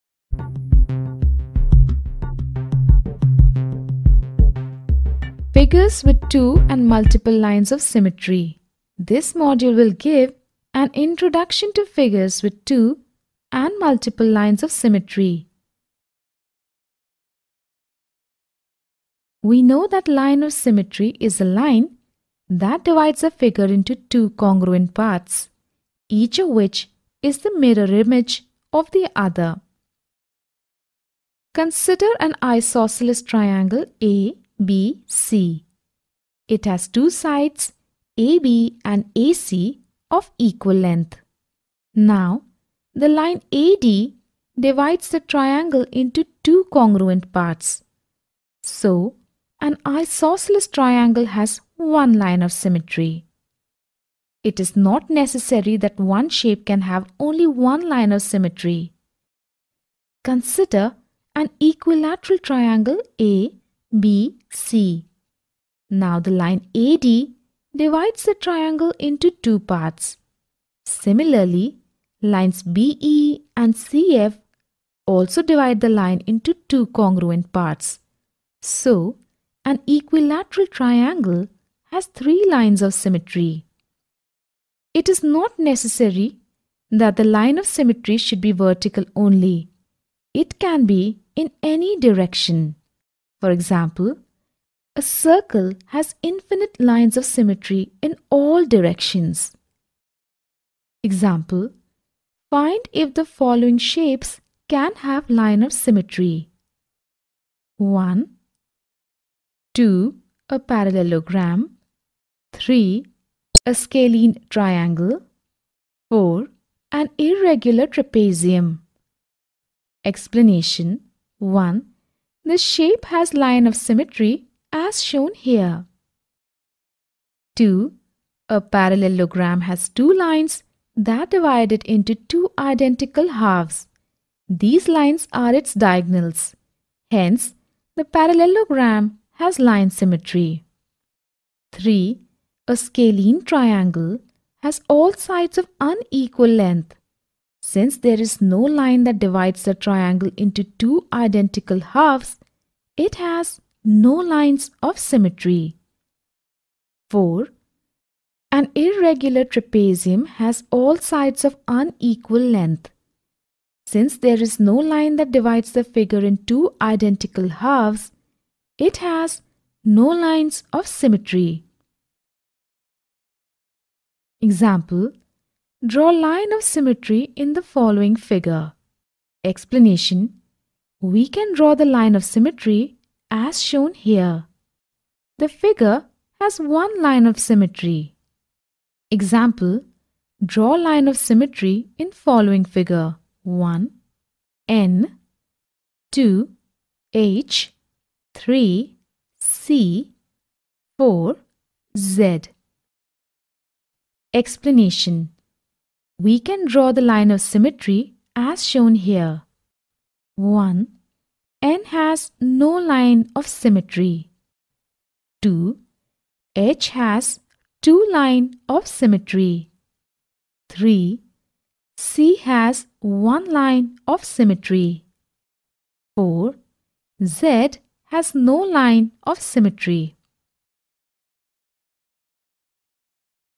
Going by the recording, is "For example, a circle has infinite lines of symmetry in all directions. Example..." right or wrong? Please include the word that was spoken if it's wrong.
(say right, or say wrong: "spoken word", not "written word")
right.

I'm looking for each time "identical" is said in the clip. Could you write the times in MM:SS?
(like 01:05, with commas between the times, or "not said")
02:12, 02:31, 02:46.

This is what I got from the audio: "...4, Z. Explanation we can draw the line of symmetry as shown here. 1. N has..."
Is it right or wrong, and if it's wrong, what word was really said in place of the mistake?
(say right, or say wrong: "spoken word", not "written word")
right.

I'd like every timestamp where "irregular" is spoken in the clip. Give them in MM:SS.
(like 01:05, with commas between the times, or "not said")
01:57, 02:38.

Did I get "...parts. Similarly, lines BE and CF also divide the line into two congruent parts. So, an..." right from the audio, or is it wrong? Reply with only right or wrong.
right.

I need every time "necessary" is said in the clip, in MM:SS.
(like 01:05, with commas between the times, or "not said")
00:55, 01:25.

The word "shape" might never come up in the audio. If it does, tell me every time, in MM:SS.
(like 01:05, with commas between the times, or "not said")
00:56, 01:43, 02:02.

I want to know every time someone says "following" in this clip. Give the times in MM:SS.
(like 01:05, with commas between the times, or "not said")
01:43, 02:57, 03:12.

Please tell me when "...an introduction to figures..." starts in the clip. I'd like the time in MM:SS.
00:10.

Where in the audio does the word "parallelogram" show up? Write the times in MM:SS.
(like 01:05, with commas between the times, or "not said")
01:50, 02:08, 02:18.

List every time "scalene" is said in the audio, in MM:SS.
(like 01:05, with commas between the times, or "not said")
01:53, 02:22.